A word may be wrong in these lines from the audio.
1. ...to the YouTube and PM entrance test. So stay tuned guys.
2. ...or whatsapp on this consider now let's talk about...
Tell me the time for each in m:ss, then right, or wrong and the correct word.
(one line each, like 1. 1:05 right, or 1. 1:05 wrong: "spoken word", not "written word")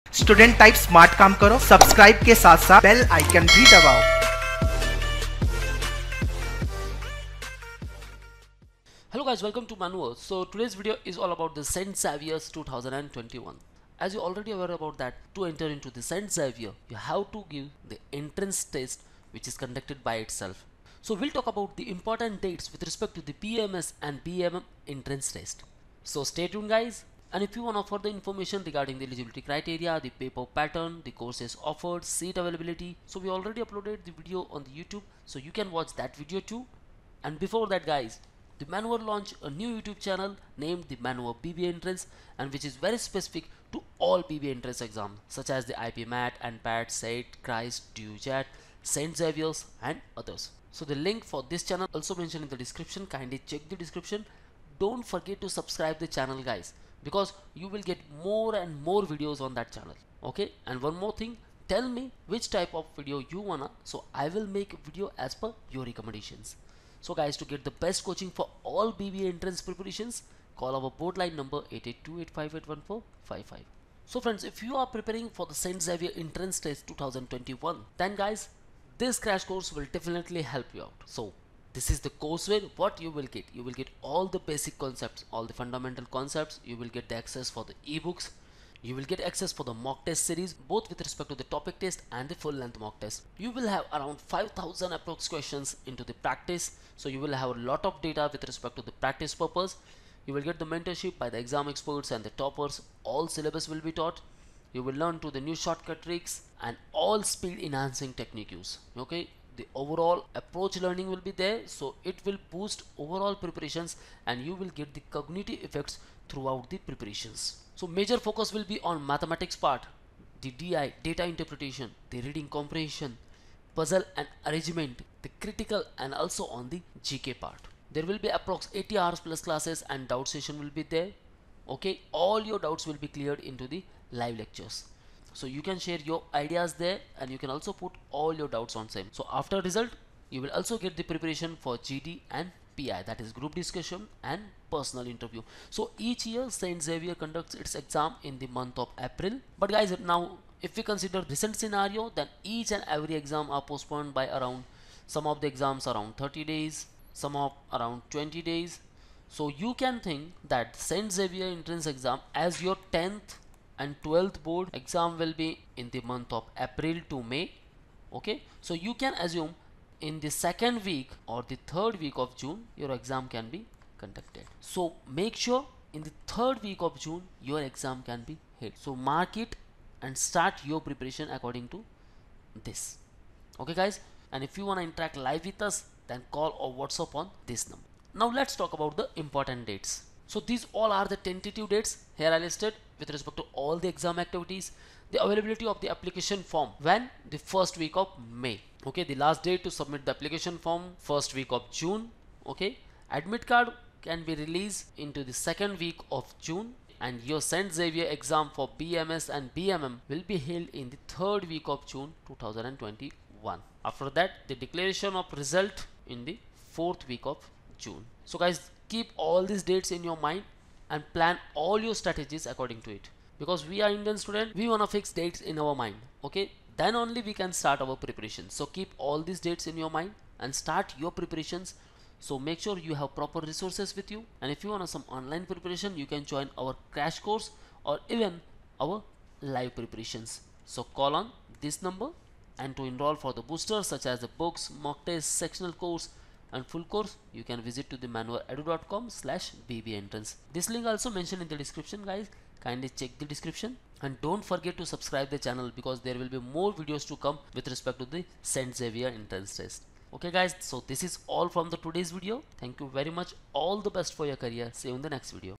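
1. 0:23 wrong: "BMS", not "YouTube"
2. 3:06 wrong: "number", not "consider".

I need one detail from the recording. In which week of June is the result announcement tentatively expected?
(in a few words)
Fourth week.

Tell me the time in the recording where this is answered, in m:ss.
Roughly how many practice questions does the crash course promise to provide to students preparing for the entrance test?
1:34.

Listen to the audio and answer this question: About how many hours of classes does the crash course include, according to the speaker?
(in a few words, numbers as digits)
80 hours.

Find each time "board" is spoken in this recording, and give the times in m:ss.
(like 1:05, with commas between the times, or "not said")
1:11, 2:44.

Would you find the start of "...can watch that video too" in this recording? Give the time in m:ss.
0:35.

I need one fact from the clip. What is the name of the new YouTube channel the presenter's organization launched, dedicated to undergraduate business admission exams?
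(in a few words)
Manoeuvre BBA Entrance.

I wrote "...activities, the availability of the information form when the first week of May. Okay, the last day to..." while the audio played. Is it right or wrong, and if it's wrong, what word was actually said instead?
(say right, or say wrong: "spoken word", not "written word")
wrong: "application", not "information".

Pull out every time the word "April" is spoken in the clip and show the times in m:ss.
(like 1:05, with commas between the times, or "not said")
2:28, 2:46.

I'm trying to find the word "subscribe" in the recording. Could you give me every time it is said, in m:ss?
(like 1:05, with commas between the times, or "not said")
0:55, 4:14.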